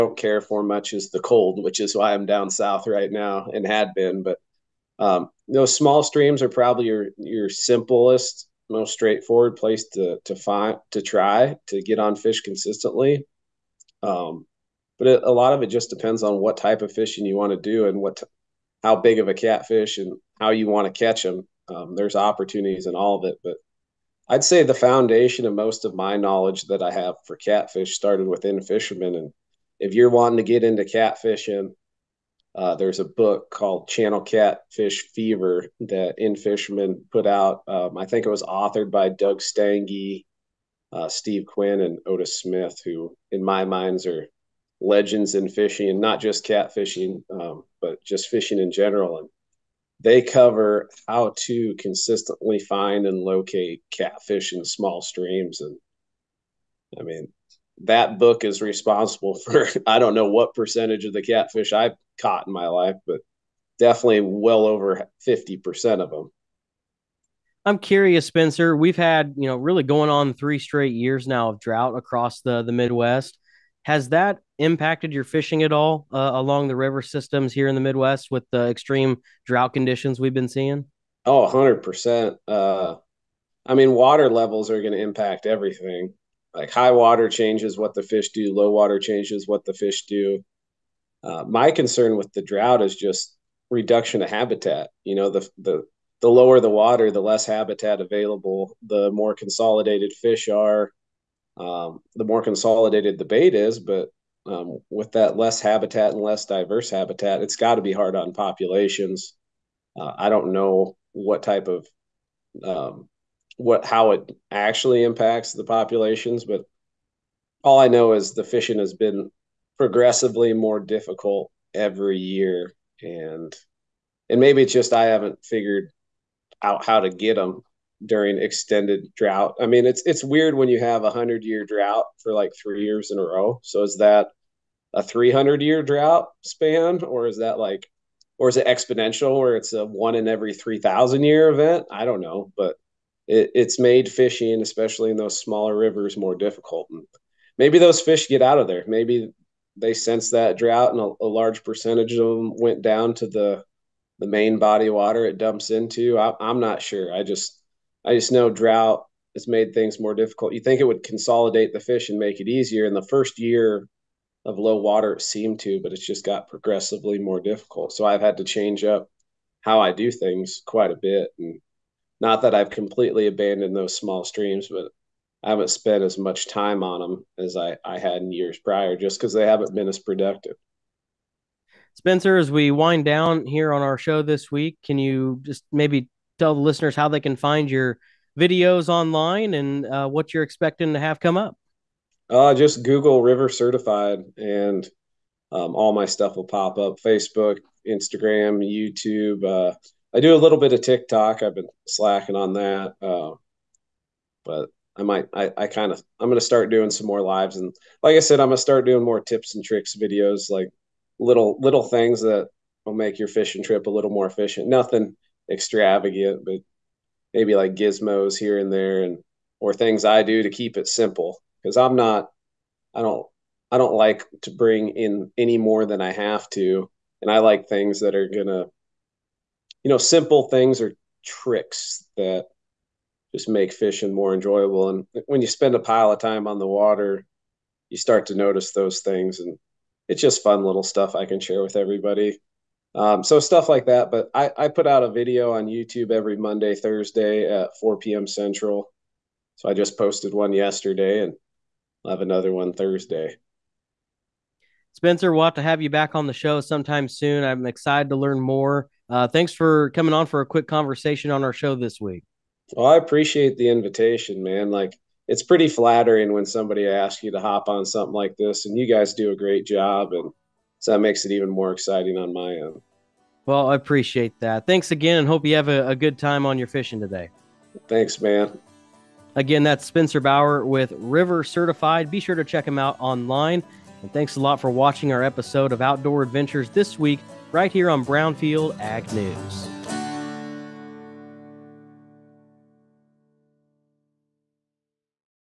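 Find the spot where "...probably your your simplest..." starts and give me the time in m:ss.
0:06.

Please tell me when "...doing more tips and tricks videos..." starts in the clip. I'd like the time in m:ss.
3:28.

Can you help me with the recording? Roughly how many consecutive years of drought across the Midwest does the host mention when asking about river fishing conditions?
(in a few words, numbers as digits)
3.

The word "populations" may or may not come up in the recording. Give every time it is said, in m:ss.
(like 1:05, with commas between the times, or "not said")
1:48, 1:55.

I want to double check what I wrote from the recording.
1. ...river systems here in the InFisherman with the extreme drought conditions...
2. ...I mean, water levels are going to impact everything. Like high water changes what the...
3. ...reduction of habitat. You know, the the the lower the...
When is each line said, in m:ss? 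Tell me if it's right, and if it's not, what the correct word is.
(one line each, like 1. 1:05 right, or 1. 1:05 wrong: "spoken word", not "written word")
1. 1:16 wrong: "Midwest", not "InFisherman"
2. 1:23 right
3. 1:33 right.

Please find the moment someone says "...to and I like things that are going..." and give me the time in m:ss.
3:46.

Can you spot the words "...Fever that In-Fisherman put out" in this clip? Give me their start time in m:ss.
0:35.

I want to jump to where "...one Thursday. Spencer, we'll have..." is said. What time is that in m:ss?
4:12.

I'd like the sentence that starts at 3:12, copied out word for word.
Uh, just Google River Certified and um, all my stuff will pop up Facebook, Instagram, YouTube.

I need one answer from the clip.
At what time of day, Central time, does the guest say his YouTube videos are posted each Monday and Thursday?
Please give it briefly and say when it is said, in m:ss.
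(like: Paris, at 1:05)
4 p.m., at 4:07.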